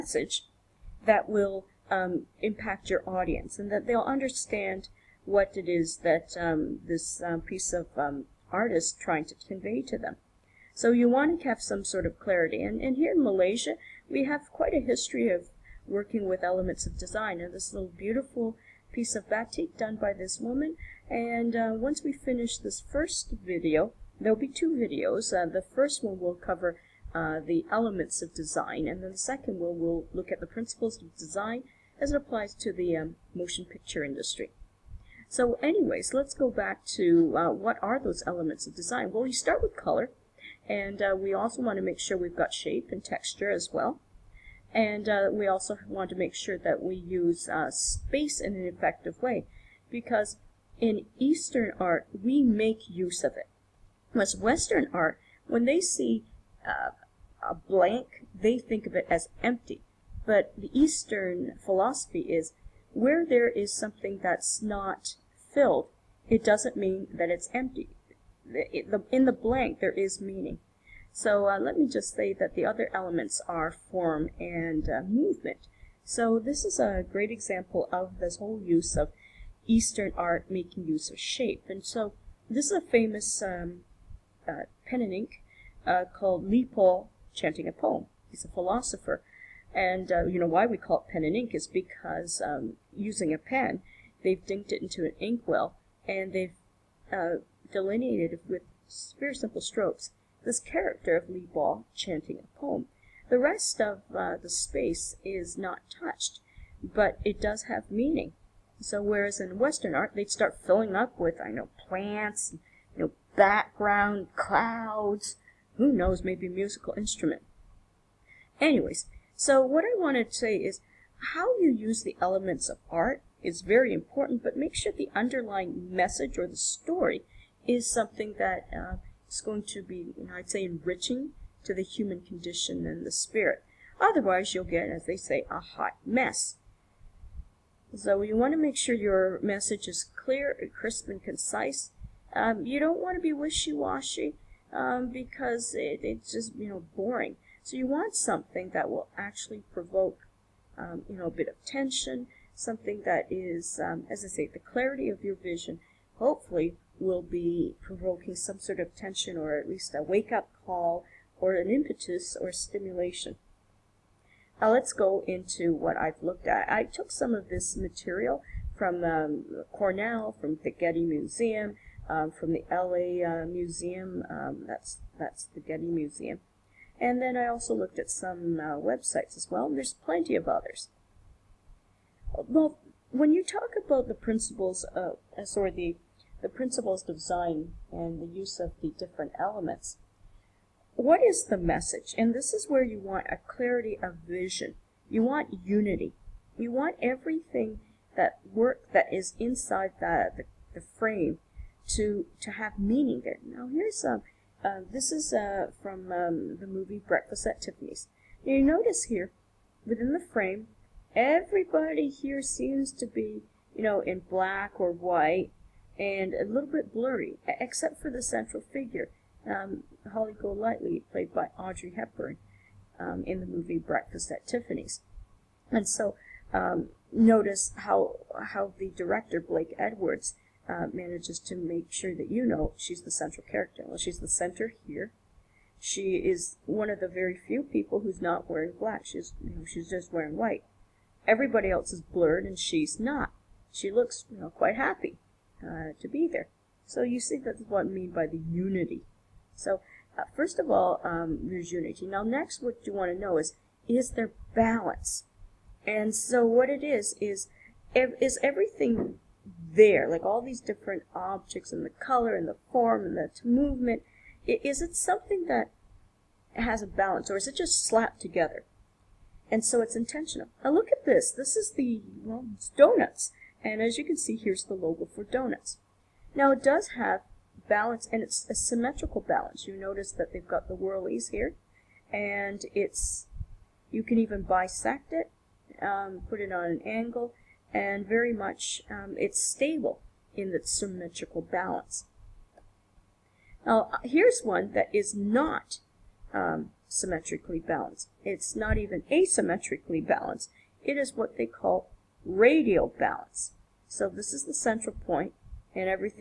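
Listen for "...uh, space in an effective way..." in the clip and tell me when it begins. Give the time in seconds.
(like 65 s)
47 s.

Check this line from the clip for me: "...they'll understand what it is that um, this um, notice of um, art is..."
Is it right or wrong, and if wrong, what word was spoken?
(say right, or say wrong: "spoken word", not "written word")
wrong: "piece", not "notice".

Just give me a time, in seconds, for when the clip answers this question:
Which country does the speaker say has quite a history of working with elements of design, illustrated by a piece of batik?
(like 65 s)
13 s.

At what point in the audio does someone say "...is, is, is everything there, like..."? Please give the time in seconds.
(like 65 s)
256 s.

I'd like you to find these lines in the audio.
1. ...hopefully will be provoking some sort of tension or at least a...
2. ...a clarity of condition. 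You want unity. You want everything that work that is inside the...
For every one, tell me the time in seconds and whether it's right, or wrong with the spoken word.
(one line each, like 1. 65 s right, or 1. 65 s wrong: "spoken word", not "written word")
1. 156 s right
2. 193 s wrong: "vision", not "condition".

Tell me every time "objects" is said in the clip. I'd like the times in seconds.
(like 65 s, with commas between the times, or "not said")
261 s.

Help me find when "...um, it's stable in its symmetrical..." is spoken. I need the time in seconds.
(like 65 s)
288 s.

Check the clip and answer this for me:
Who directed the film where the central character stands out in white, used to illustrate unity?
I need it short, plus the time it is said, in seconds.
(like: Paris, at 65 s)
Blake Edwards, at 229 s.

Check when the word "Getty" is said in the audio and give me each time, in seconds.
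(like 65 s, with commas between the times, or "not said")
170 s, 175 s.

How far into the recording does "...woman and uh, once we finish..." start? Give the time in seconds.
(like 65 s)
20 s.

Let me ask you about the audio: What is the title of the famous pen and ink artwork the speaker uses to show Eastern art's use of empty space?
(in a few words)
Po chanting a poem.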